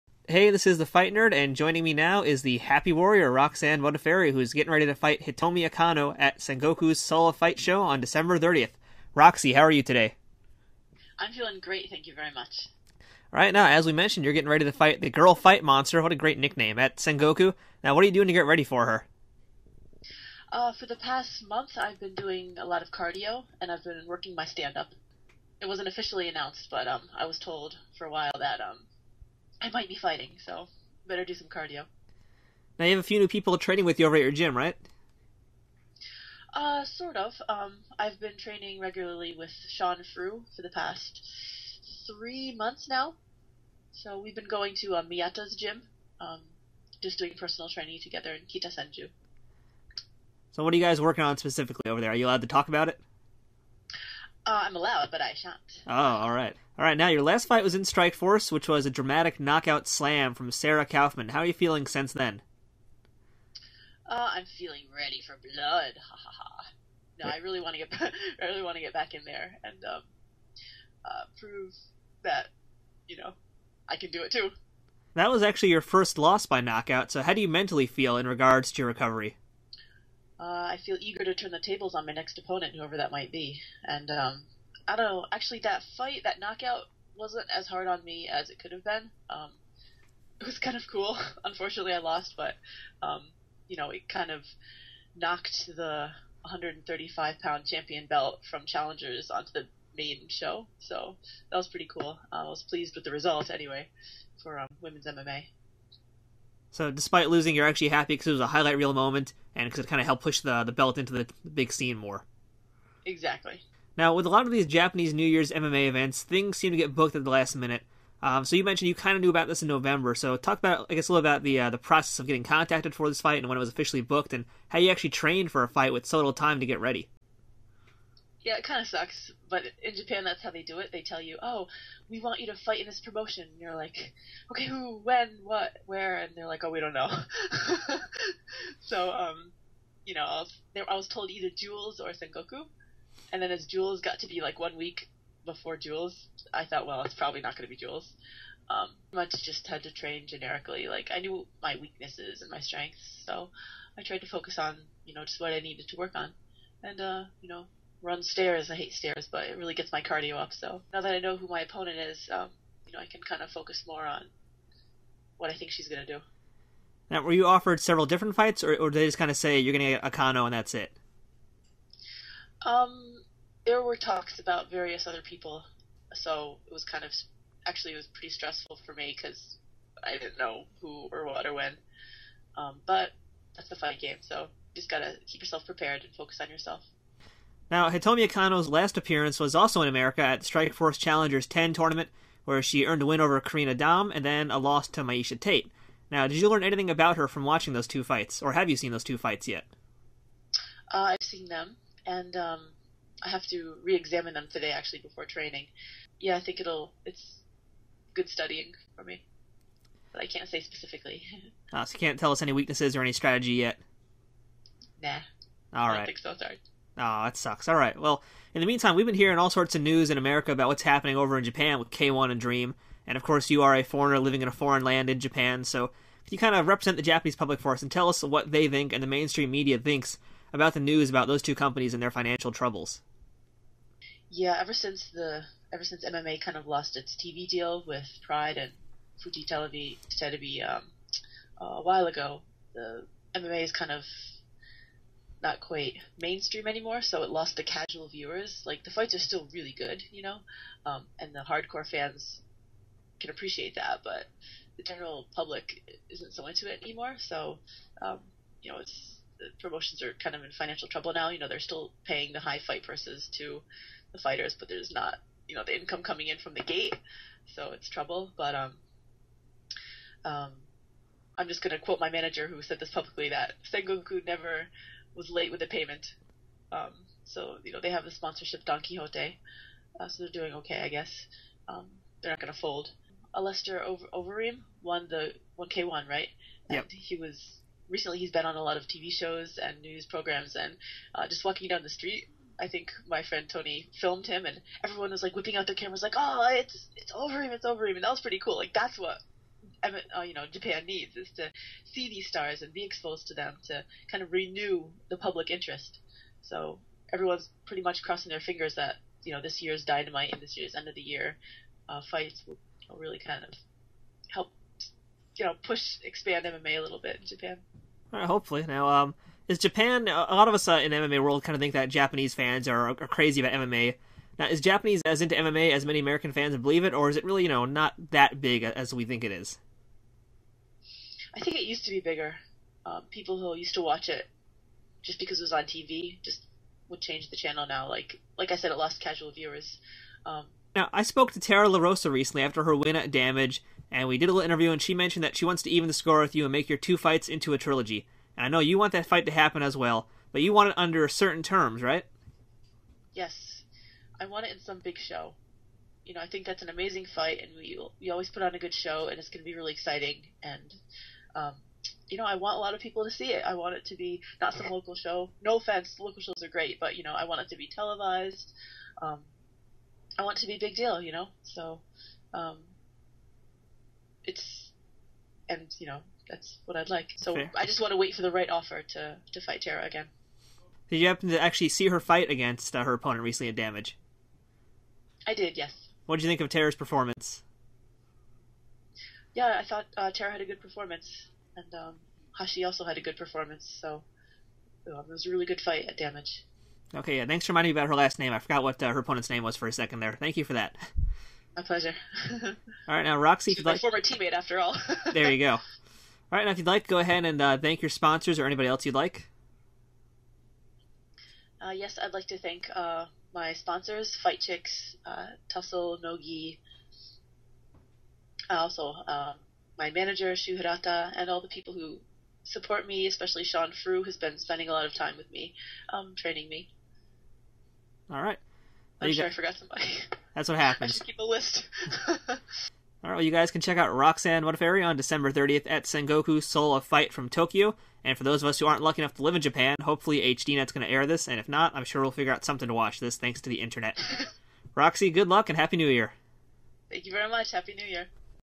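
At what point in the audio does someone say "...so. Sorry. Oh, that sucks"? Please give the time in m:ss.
3:36.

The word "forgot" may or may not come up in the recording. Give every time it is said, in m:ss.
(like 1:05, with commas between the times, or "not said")
6:38, 7:09.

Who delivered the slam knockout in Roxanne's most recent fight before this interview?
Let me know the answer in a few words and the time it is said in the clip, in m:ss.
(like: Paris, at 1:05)
Sarah Kaufman, at 1:00.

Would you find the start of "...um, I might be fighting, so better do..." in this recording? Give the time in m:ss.
0:28.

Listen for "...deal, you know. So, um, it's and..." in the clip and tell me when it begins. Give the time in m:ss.
6:10.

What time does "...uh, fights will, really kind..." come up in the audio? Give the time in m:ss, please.
5:11.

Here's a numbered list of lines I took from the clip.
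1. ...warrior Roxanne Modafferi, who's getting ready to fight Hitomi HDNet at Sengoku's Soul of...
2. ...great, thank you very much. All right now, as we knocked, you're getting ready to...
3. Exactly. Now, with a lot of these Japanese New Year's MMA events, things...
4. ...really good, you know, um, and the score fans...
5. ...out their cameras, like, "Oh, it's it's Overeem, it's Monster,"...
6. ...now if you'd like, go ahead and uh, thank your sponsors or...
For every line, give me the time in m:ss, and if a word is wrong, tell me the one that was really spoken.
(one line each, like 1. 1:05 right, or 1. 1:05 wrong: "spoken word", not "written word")
1. 0:02 wrong: "Akano", not "HDNet"
2. 0:11 wrong: "mentioned", not "knocked"
3. 1:53 right
4. 4:09 wrong: "hardcore", not "score"
5. 4:55 wrong: "Overeem", not "Monster"
6. 6:46 right.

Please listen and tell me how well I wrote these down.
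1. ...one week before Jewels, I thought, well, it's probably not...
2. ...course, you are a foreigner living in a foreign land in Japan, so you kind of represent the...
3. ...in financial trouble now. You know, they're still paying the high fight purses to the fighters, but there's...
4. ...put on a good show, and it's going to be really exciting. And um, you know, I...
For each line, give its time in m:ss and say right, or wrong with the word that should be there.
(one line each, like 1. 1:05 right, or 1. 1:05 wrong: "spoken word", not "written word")
1. 2:24 right
2. 3:43 right
3. 4:20 right
4. 5:58 right.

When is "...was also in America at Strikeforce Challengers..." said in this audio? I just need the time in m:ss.
3:09.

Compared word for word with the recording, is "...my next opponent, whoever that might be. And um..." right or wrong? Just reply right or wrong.
right.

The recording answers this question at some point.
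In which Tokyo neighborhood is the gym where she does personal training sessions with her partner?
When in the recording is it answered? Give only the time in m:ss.
0:48.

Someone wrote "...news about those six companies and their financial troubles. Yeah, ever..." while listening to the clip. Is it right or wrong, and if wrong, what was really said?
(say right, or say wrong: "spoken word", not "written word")
wrong: "two", not "six".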